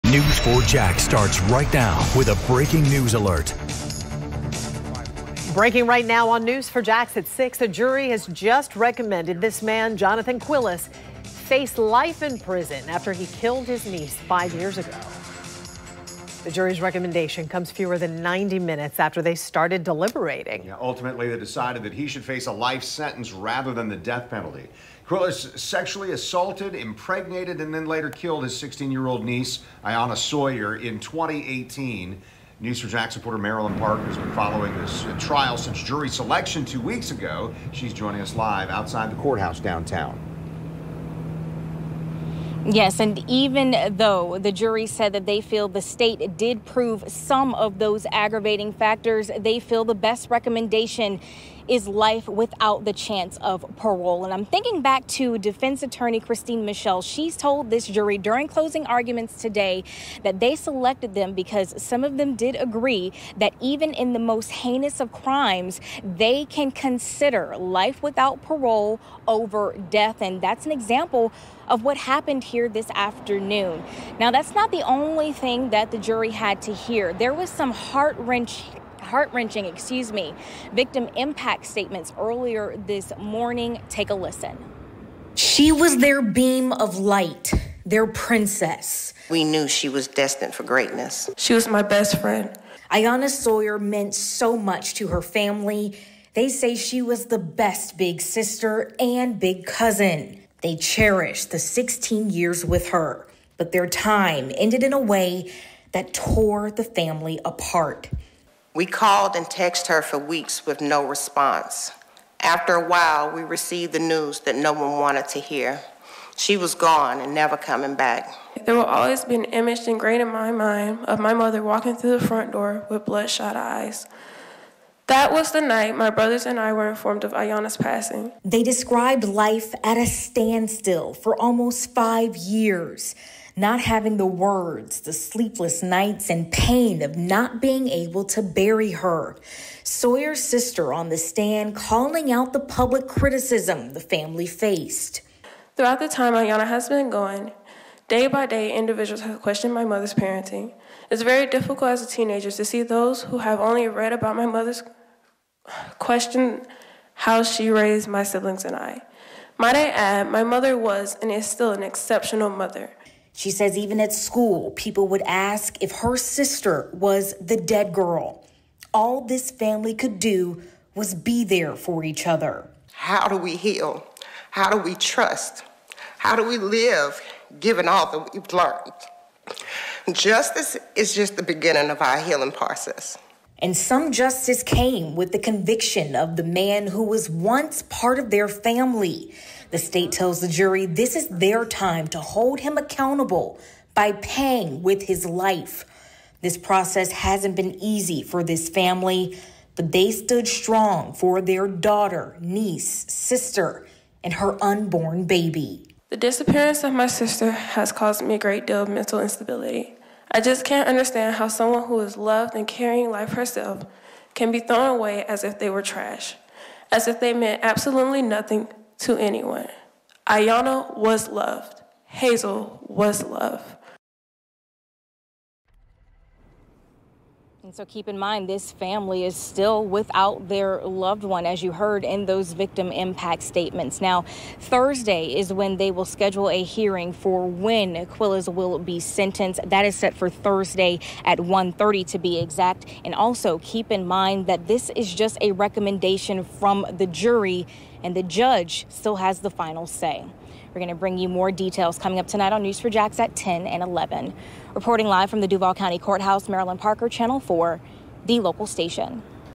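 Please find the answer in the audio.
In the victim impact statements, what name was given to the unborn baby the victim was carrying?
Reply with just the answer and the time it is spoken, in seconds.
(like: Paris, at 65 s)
Hazel, at 222 s.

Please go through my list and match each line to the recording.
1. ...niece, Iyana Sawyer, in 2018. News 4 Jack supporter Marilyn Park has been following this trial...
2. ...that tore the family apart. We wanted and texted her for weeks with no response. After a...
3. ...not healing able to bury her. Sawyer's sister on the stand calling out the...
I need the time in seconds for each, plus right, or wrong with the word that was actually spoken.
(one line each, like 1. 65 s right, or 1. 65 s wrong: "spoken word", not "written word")
1. 29 s right
2. 105 s wrong: "called", not "wanted"
3. 137 s wrong: "being", not "healing".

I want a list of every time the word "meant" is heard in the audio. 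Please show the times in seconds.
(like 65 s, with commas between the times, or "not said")
93 s, 217 s.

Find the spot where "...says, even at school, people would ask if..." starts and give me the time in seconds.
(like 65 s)
163 s.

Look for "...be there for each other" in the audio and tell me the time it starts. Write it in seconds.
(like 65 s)
171 s.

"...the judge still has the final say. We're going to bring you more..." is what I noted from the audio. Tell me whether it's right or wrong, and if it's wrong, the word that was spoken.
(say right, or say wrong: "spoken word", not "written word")
right.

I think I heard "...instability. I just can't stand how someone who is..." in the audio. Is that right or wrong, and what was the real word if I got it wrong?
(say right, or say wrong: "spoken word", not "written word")
wrong: "understand", not "stand".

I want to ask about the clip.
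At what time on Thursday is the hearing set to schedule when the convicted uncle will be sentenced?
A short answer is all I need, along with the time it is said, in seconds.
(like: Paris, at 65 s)
1:30, at 241 s.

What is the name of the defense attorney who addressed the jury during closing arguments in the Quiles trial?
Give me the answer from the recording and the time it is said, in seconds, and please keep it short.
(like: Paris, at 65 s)
Christine Michelle, at 56 s.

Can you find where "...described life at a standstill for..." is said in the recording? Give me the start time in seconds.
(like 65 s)
128 s.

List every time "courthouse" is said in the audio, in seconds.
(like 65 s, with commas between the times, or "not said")
39 s, 255 s.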